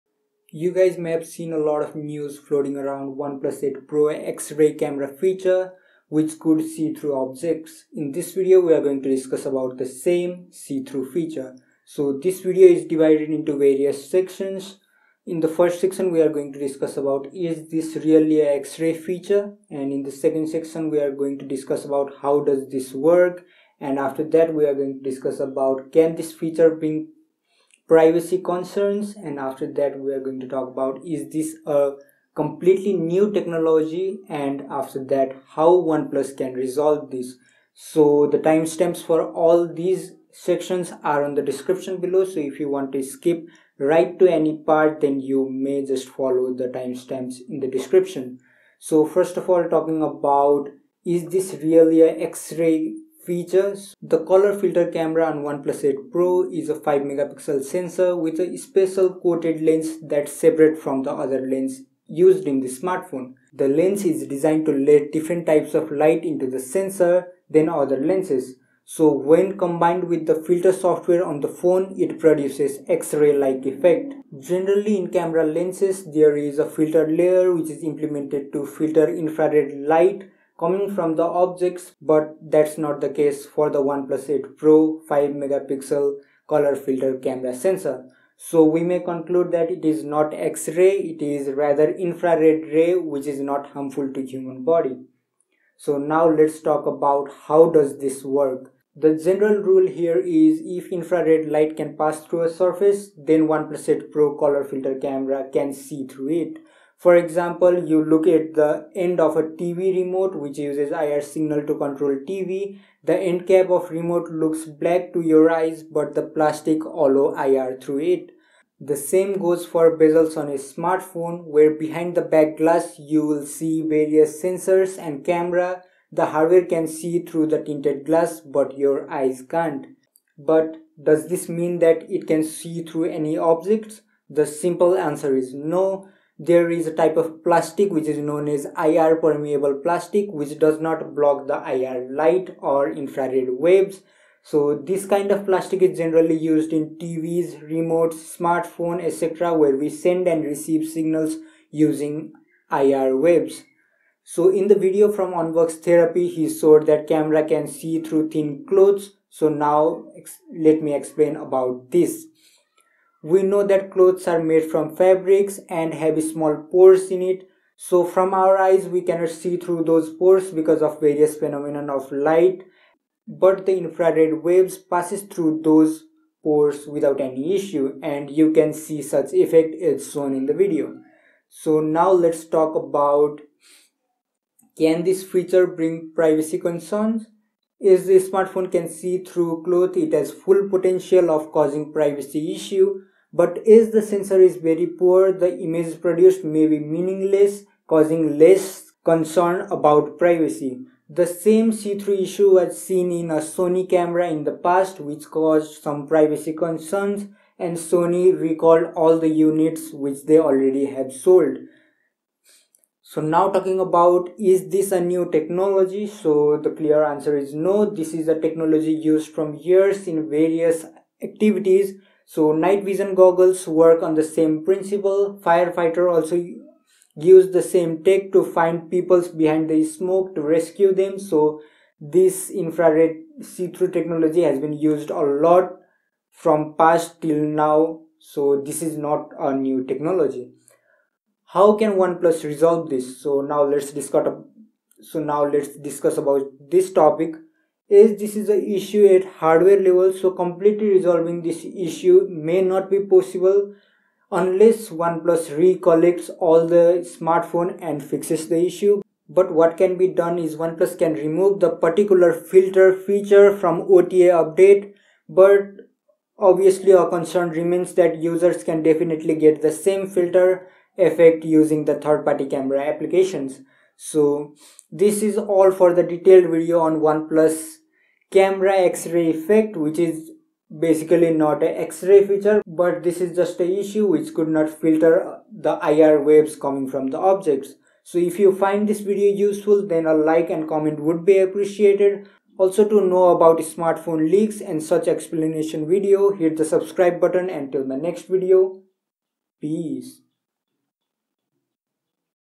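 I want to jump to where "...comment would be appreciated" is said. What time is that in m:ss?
4:50.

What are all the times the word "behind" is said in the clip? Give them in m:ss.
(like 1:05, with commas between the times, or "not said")
2:01, 3:49.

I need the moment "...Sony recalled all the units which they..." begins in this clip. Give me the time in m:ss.
3:27.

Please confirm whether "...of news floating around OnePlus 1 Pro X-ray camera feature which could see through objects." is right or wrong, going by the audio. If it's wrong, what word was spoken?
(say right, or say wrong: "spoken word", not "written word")
wrong: "8", not "1".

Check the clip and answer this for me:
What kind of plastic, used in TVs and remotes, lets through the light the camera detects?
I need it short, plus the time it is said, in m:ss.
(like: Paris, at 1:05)
IR permeable plastic, at 2:18.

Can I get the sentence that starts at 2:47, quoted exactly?
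So from our eyes, we cannot see through those pores because of various phenomenon of light.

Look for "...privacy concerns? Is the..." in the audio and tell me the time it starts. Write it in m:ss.
3:06.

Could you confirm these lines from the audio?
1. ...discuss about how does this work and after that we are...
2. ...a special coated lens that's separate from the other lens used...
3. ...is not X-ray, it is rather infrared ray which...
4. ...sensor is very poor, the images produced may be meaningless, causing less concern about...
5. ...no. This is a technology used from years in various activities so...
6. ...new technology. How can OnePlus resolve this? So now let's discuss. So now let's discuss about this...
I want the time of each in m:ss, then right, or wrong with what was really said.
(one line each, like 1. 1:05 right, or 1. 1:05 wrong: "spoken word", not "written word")
1. 0:21 right
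2. 0:58 right
3. 1:29 right
4. 3:14 right
5. 3:37 right
6. 3:59 right.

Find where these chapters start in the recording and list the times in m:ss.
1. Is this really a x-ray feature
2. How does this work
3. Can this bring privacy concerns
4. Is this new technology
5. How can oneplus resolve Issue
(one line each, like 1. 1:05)
1. 0:50
2. 1:35
3. 3:05
4. 3:30
5. 4:00.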